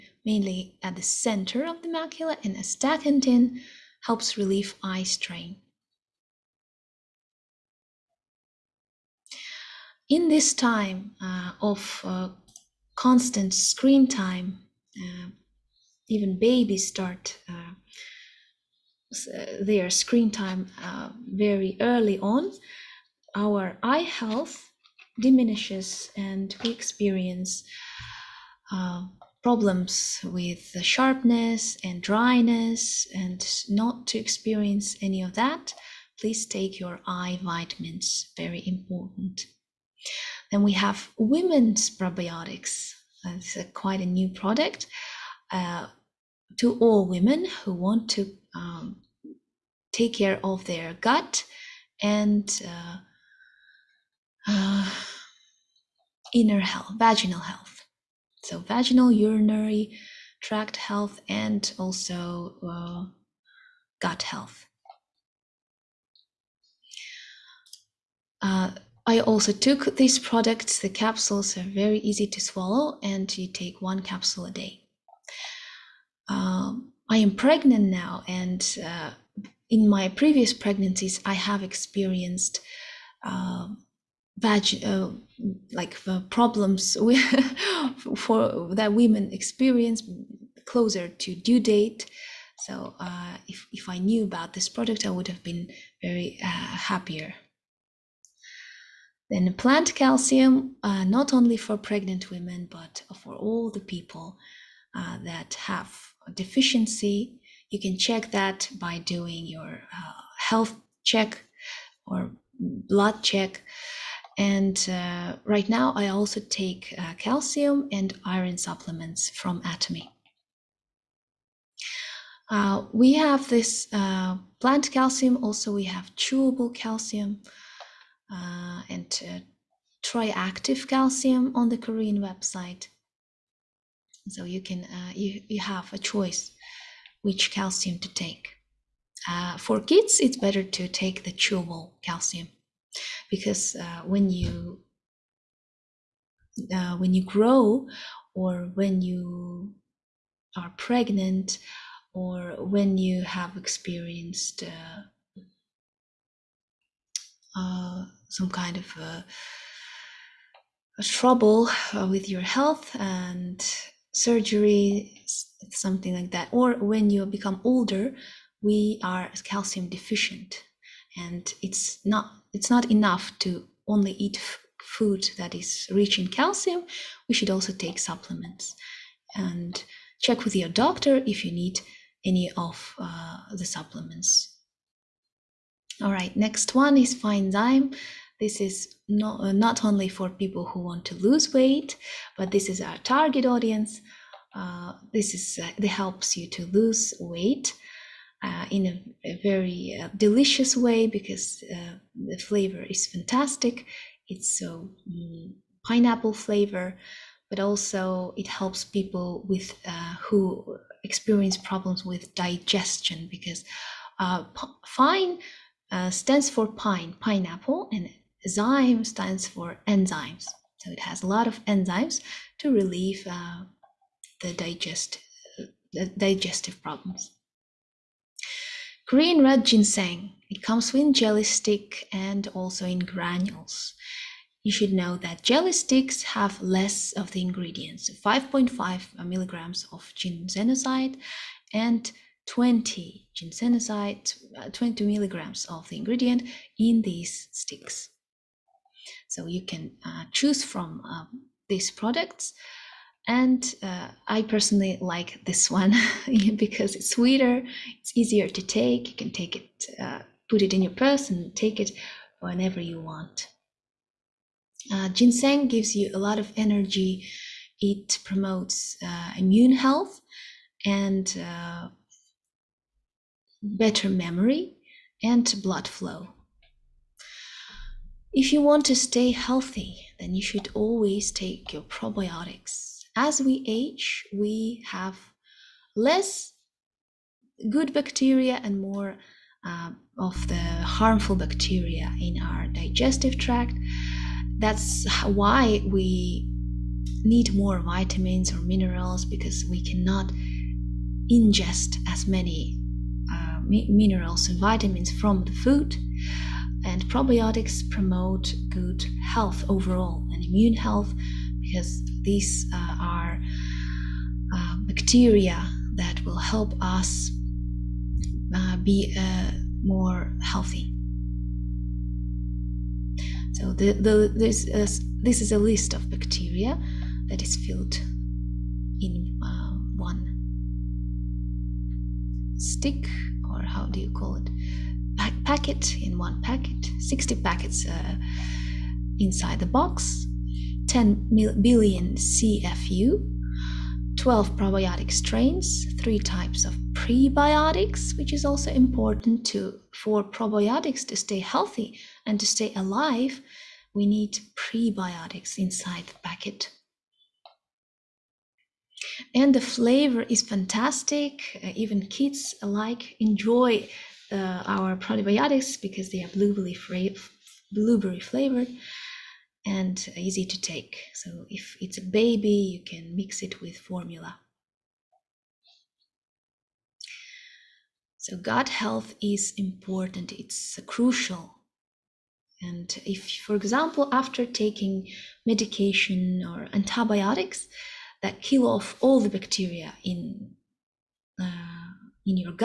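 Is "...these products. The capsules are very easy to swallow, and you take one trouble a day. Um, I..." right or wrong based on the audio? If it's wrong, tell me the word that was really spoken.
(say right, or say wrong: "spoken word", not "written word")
wrong: "capsule", not "trouble".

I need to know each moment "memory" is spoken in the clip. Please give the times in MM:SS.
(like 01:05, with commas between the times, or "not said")
04:34.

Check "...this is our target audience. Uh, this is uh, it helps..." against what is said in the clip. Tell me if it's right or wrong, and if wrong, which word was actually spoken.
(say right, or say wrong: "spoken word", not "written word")
right.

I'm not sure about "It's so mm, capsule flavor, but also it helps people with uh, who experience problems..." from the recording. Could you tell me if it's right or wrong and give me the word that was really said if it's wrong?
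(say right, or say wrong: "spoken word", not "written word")
wrong: "pineapple", not "capsule".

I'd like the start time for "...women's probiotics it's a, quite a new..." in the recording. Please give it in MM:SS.
00:41.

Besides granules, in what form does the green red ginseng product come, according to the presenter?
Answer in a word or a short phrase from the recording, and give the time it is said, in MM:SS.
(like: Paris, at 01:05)
jelly stick, at 03:51.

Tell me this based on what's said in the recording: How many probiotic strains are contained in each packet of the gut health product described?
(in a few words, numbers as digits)
12.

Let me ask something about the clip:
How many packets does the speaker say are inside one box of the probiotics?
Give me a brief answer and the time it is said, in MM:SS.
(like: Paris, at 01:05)
60, at 05:36.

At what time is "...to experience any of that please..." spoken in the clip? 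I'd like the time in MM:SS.
00:34.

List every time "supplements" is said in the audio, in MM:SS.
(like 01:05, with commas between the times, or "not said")
01:58, 02:57, 03:03.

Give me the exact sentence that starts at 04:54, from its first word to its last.
That's why we need more vitamins or minerals because we cannot ingest as many uh, mi minerals and vitamins from the food.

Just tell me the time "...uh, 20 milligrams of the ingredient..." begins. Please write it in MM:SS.
04:04.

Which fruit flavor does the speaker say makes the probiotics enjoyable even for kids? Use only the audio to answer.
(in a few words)
blueberry.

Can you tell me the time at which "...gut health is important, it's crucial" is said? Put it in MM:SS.
06:18.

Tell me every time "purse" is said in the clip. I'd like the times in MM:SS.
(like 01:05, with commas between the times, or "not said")
04:20.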